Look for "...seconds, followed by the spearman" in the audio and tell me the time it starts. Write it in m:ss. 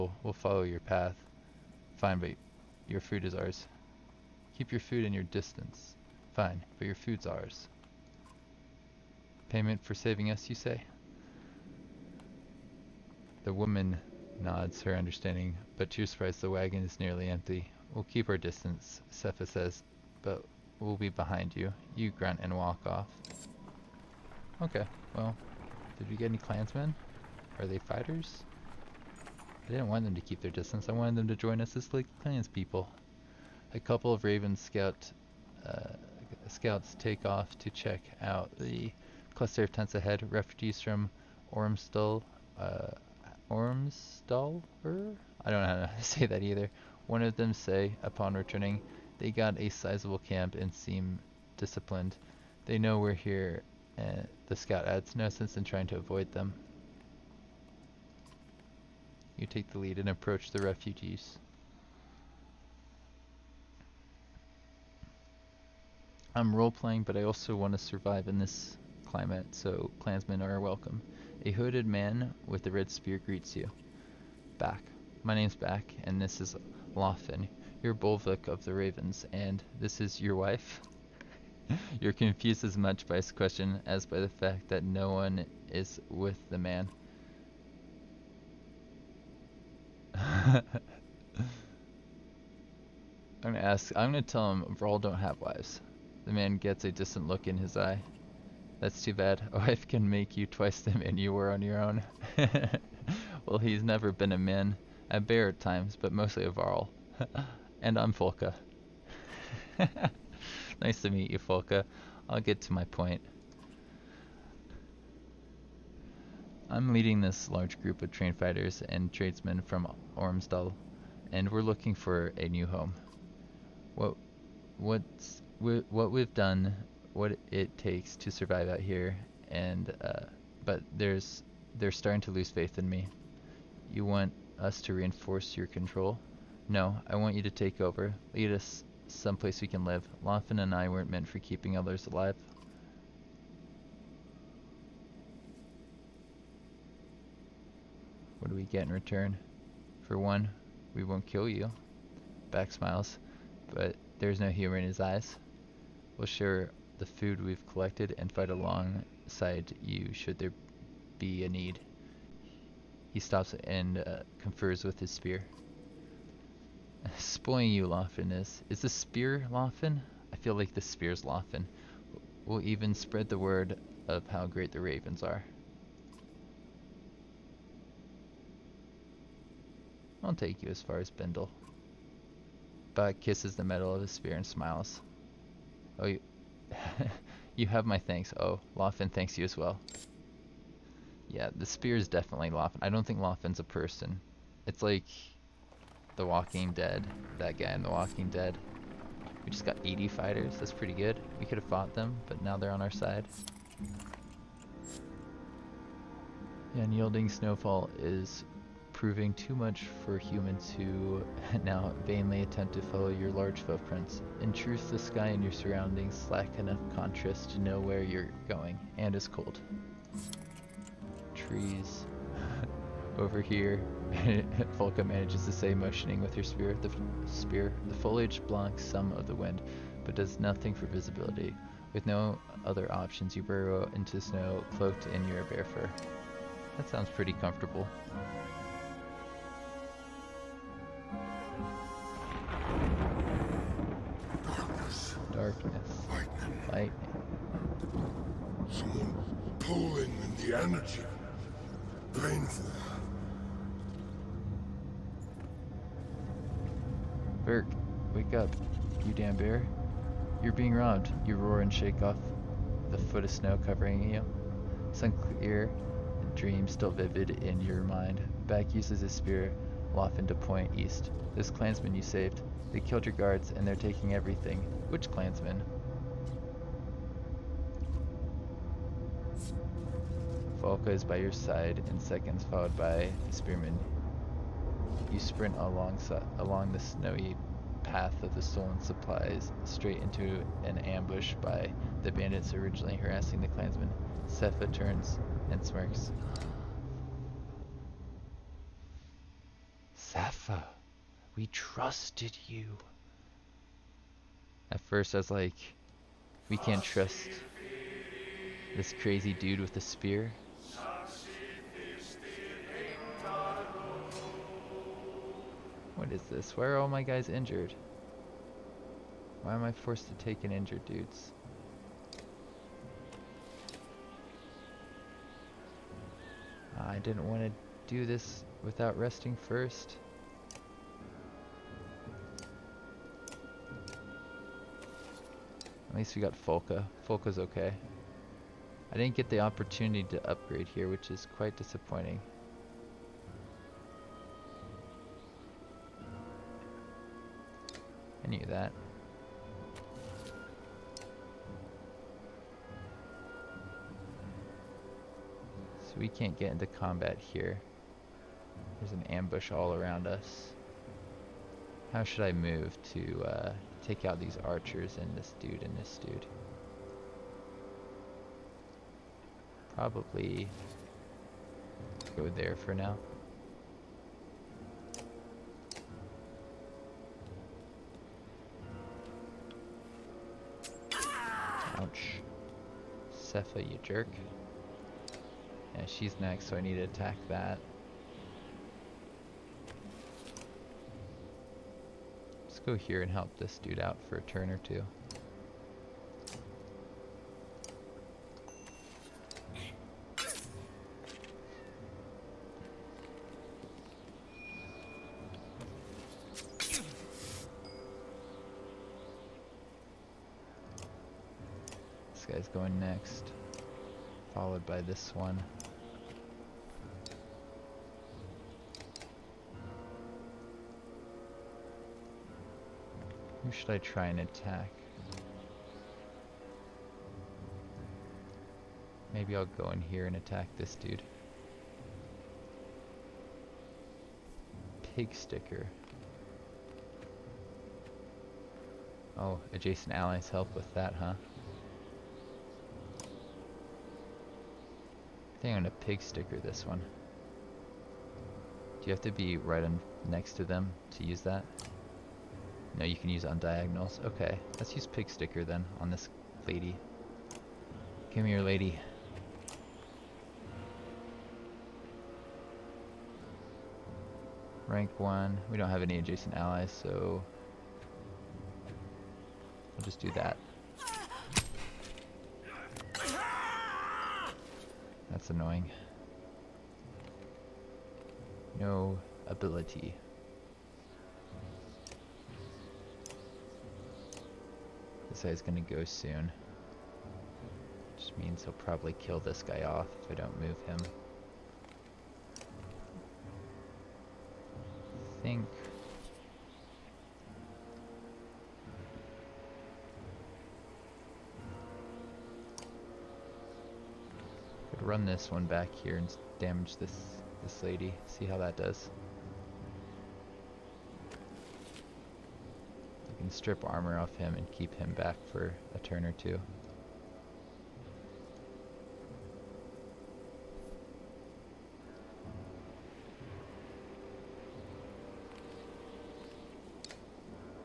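4:41.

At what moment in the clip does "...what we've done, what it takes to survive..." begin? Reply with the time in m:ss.
2:05.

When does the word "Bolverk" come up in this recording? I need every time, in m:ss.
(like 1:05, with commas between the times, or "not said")
1:17.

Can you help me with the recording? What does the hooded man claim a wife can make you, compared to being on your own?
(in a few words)
twice the man.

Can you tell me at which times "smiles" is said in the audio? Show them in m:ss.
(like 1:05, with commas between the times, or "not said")
2:32, 3:04.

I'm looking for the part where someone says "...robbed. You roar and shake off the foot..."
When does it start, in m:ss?
4:20.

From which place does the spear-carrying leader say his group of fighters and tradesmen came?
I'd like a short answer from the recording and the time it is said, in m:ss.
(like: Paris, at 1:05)
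Ormsdal, at 2:00.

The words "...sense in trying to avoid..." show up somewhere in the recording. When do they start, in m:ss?
0:55.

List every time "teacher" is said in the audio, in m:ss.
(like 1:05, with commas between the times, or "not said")
not said.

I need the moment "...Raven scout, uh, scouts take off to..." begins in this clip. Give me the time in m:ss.
0:34.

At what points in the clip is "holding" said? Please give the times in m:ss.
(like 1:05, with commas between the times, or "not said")
not said.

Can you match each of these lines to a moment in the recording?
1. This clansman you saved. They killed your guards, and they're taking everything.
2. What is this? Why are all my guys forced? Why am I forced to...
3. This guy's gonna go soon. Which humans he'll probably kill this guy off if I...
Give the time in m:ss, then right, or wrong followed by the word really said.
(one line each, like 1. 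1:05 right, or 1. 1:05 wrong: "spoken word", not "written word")
1. 4:31 right
2. 5:16 wrong: "injured", not "forced"
3. 8:05 wrong: "means", not "humans".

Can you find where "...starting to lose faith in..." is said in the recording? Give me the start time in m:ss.
2:11.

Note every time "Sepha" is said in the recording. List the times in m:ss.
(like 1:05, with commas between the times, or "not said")
0:19, 4:54, 4:59, 6:23.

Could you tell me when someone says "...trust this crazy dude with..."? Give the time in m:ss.
5:06.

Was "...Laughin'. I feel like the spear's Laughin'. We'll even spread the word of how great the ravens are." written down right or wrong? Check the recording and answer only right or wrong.
right.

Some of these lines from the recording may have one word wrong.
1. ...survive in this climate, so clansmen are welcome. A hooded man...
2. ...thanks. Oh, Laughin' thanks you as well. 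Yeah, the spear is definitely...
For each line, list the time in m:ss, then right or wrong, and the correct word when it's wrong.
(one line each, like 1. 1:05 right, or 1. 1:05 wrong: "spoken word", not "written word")
1. 1:07 right
2. 3:07 right.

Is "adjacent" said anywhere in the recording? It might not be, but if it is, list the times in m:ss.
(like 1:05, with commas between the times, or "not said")
7:19, 7:45.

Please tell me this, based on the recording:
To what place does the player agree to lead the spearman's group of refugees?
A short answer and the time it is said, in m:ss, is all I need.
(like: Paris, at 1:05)
Bindle, at 3:01.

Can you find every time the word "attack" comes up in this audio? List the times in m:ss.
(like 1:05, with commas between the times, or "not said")
6:26, 7:04, 7:10.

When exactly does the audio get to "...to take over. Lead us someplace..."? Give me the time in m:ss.
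2:17.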